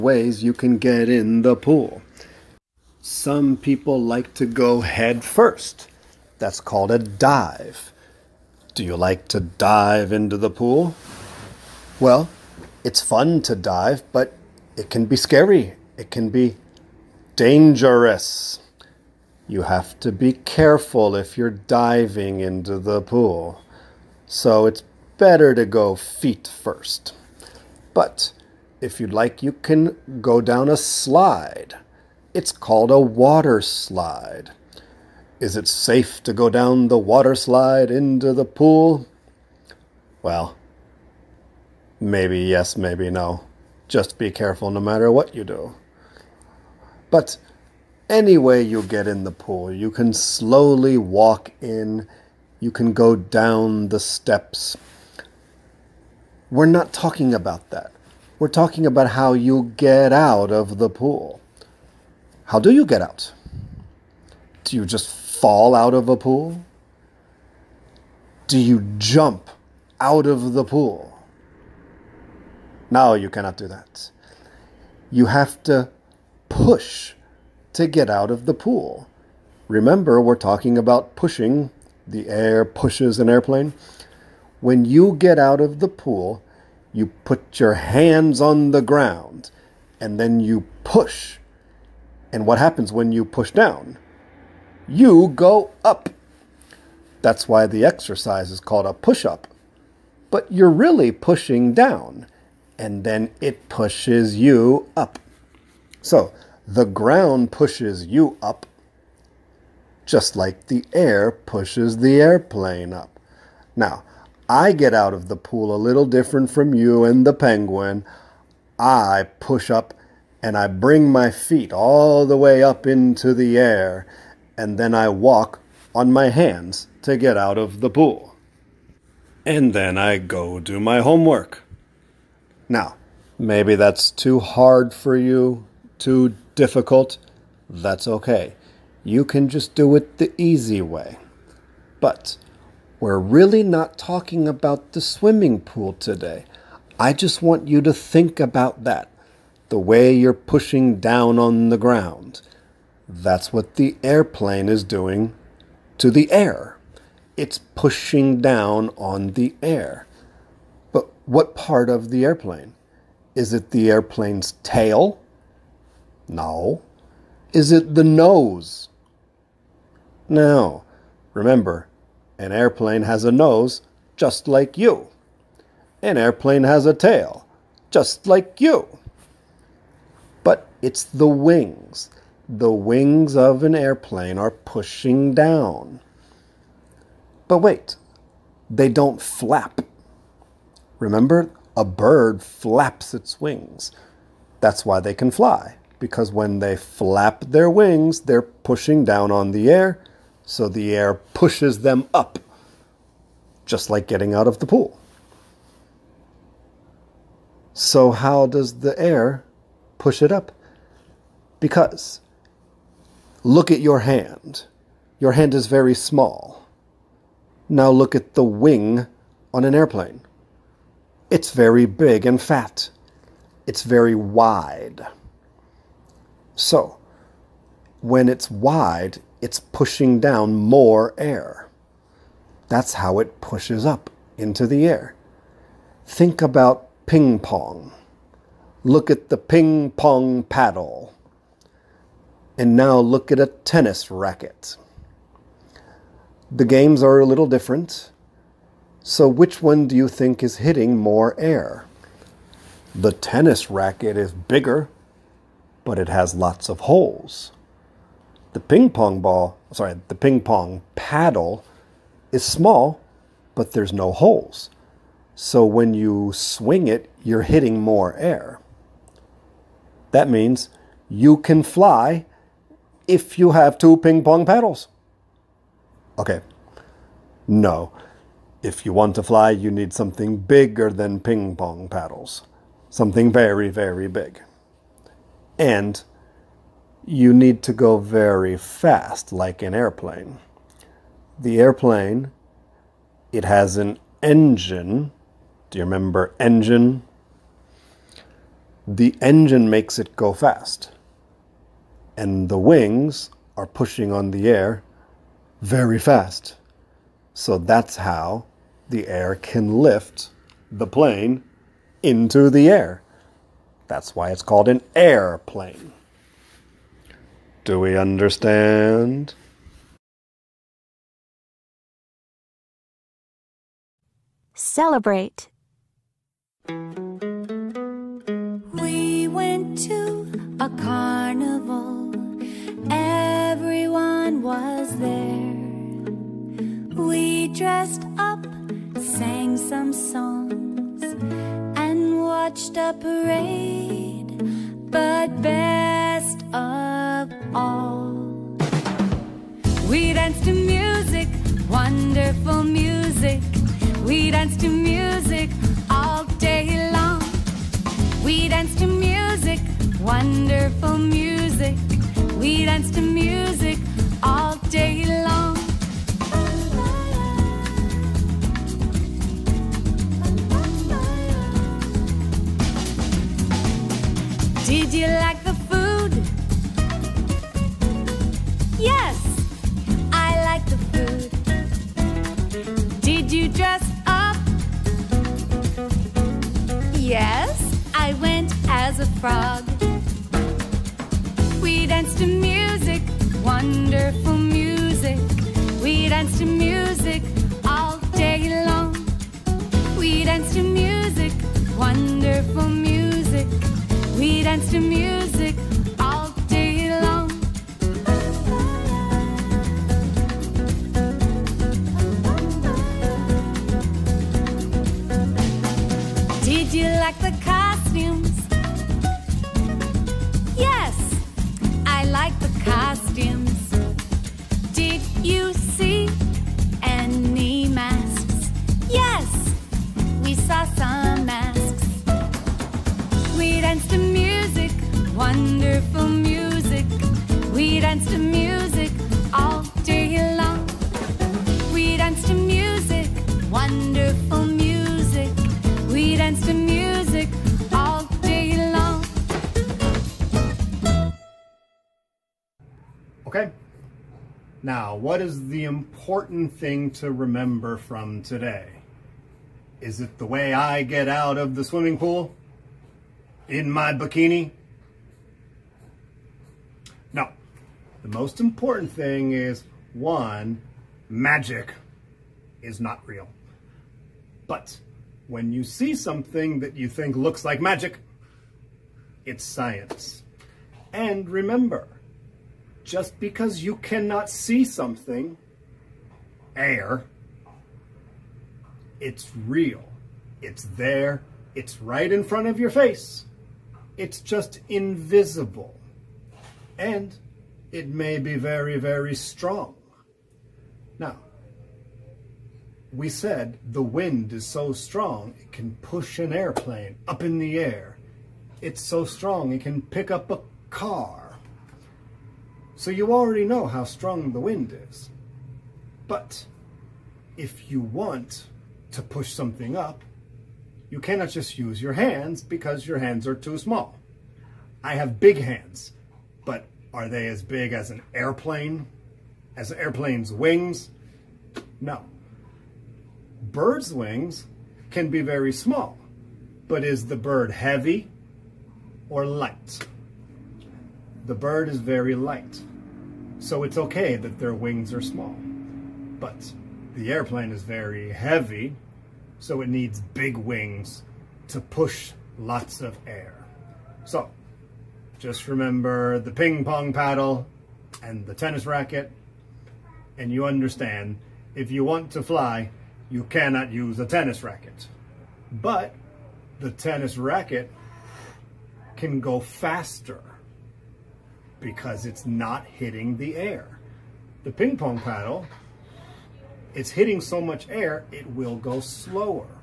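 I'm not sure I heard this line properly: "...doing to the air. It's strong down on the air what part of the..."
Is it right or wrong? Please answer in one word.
wrong.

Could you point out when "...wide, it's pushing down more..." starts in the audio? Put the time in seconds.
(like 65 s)
228 s.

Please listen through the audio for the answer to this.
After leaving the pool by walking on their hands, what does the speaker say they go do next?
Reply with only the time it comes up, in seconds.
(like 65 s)
130 s.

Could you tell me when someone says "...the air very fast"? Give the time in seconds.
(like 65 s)
304 s.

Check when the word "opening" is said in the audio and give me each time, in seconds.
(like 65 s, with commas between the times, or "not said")
not said.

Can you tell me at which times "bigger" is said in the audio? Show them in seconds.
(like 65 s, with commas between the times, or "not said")
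254 s, 280 s.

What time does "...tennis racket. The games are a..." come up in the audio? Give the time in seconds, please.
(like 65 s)
243 s.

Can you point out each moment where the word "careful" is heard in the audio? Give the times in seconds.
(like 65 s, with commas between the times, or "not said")
20 s, 44 s.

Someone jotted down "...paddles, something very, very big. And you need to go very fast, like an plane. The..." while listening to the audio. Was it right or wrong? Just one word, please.
wrong.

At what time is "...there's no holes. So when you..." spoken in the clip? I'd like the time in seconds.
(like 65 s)
263 s.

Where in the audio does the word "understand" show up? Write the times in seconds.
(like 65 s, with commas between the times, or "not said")
317 s, 560 s.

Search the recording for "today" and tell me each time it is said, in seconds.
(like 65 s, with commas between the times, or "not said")
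145 s, 458 s.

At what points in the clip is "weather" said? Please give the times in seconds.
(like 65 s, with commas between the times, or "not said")
not said.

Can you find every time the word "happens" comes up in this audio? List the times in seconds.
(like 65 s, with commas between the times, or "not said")
92 s.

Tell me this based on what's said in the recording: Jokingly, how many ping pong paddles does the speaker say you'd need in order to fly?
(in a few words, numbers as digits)
2.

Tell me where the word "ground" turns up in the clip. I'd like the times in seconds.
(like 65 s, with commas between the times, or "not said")
88 s, 106 s, 151 s.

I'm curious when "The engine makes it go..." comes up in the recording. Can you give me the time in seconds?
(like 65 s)
298 s.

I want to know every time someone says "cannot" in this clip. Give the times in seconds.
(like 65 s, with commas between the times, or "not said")
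73 s, 483 s, 520 s, 563 s.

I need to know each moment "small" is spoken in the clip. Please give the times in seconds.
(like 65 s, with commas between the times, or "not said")
215 s, 262 s, 523 s, 535 s, 544 s.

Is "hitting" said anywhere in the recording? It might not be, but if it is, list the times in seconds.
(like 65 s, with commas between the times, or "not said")
250 s, 267 s, 572 s, 576 s.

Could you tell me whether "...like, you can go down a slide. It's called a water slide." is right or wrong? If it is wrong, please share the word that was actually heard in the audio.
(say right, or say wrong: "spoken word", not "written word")
right.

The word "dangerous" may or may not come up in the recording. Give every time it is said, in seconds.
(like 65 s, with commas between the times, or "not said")
17 s.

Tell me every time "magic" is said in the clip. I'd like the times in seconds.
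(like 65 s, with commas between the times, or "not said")
471 s, 477 s.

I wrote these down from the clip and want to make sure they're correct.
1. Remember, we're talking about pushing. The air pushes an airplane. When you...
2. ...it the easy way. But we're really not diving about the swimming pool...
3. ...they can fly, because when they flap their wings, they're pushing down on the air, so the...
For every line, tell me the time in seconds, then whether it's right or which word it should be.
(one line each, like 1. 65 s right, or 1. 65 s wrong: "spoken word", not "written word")
1. 79 s right
2. 139 s wrong: "talking", not "diving"
3. 194 s right.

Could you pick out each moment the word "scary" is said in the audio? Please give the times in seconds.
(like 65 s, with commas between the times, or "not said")
15 s.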